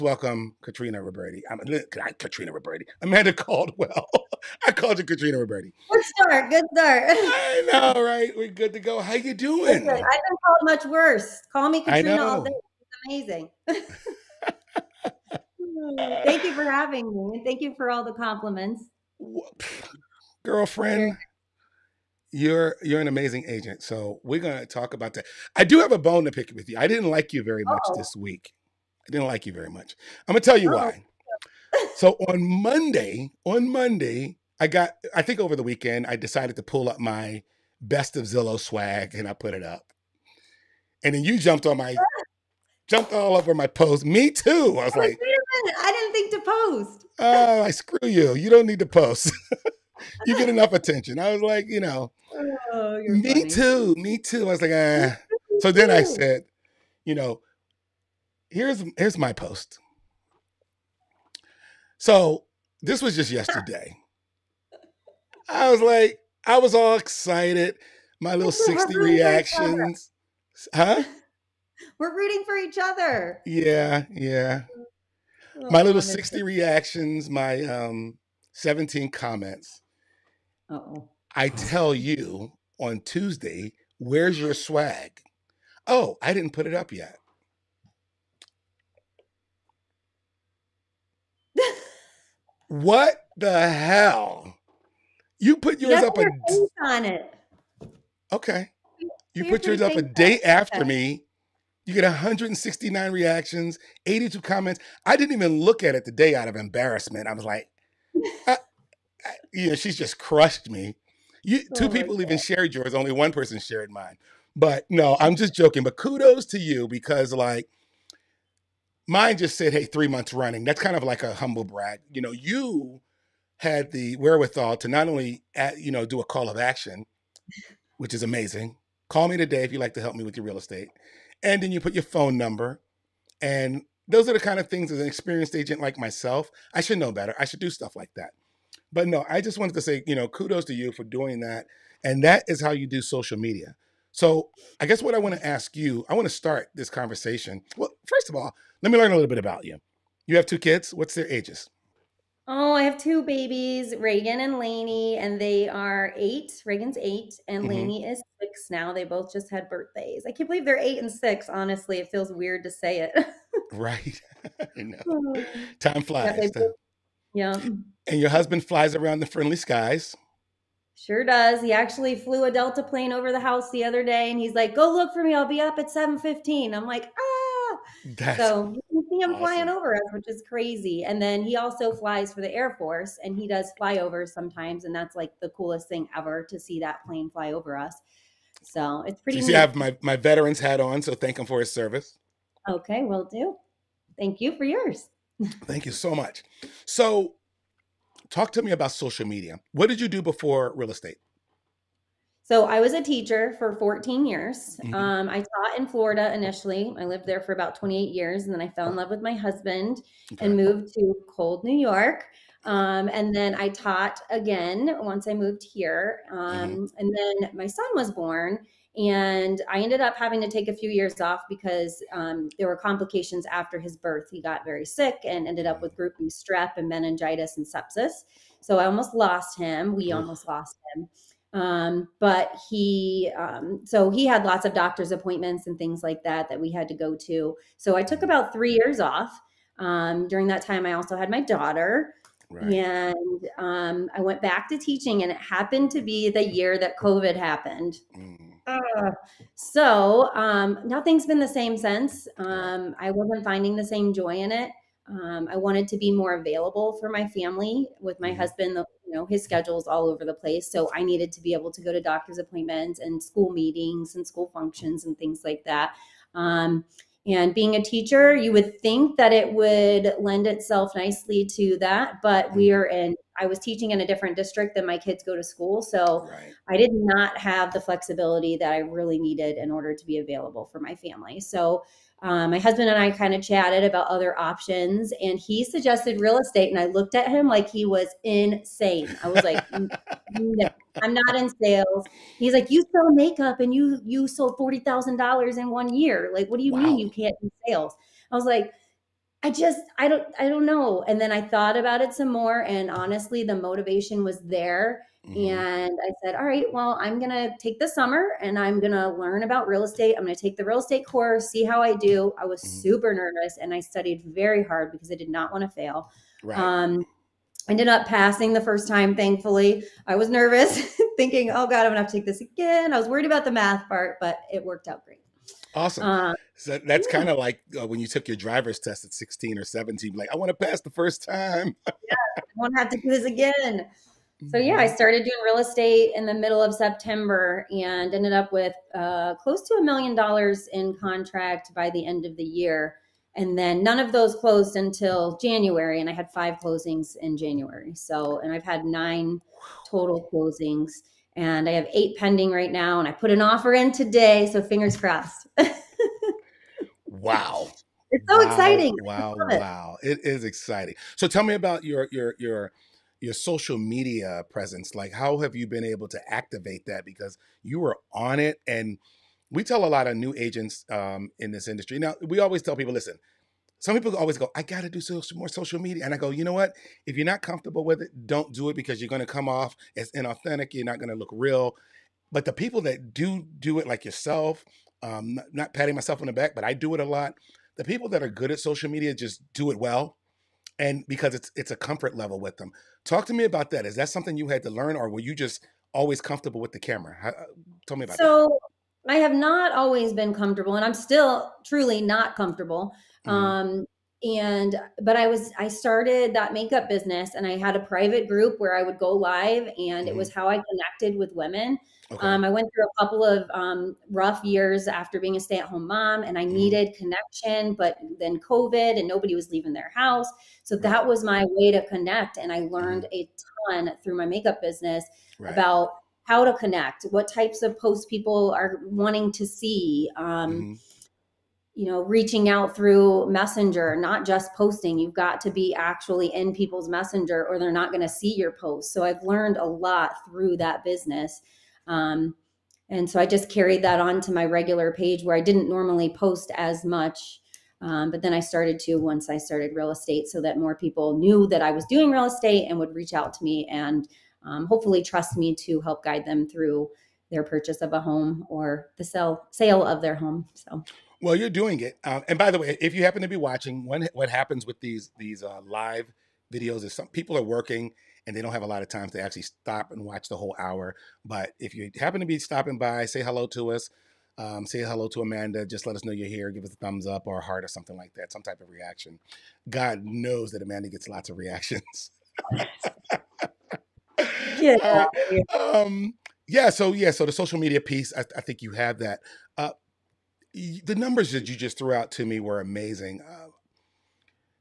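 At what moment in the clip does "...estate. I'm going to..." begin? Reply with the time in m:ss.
5:09.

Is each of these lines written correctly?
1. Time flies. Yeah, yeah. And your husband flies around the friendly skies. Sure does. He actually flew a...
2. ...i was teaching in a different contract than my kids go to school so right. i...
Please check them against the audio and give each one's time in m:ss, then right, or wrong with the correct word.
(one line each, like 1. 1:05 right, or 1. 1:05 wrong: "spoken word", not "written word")
1. 2:45 right
2. 4:33 wrong: "district", not "contract".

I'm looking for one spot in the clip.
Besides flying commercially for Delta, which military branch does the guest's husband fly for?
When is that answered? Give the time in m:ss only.
3:02.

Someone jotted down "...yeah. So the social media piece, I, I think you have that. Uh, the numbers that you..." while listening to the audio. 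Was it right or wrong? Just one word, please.
right.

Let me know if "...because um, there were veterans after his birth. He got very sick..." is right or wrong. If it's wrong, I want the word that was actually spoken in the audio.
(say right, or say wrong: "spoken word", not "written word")
wrong: "complications", not "veterans".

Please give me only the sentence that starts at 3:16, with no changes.
So talk to me about social media.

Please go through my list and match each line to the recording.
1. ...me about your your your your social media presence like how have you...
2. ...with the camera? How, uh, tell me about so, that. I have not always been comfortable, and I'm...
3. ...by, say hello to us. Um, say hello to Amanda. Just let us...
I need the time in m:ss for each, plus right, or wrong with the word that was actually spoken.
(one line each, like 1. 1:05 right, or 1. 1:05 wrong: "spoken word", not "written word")
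1. 6:01 right
2. 6:36 right
3. 7:52 right.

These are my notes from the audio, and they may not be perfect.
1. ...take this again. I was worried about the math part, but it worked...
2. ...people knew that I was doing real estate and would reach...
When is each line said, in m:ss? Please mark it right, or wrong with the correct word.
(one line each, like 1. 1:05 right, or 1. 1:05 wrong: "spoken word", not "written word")
1. 5:22 right
2. 7:30 right.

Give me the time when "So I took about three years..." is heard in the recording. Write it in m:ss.
3:57.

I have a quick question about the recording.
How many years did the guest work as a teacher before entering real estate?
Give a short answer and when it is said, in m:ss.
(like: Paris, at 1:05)
14, at 3:23.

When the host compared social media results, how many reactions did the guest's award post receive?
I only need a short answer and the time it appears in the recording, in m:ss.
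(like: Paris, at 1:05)
169, at 1:42.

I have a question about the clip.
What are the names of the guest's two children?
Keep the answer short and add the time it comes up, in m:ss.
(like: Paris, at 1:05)
Reagan and Lainey, at 2:33.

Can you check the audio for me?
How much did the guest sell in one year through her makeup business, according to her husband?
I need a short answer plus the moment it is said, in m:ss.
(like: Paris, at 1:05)
$40,000, at 4:54.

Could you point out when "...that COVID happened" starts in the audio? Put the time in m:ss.
4:06.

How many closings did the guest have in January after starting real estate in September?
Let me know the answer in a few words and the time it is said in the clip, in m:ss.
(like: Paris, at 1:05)
5, at 5:46.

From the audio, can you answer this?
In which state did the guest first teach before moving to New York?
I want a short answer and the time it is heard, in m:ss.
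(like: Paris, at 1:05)
Florida, at 3:25.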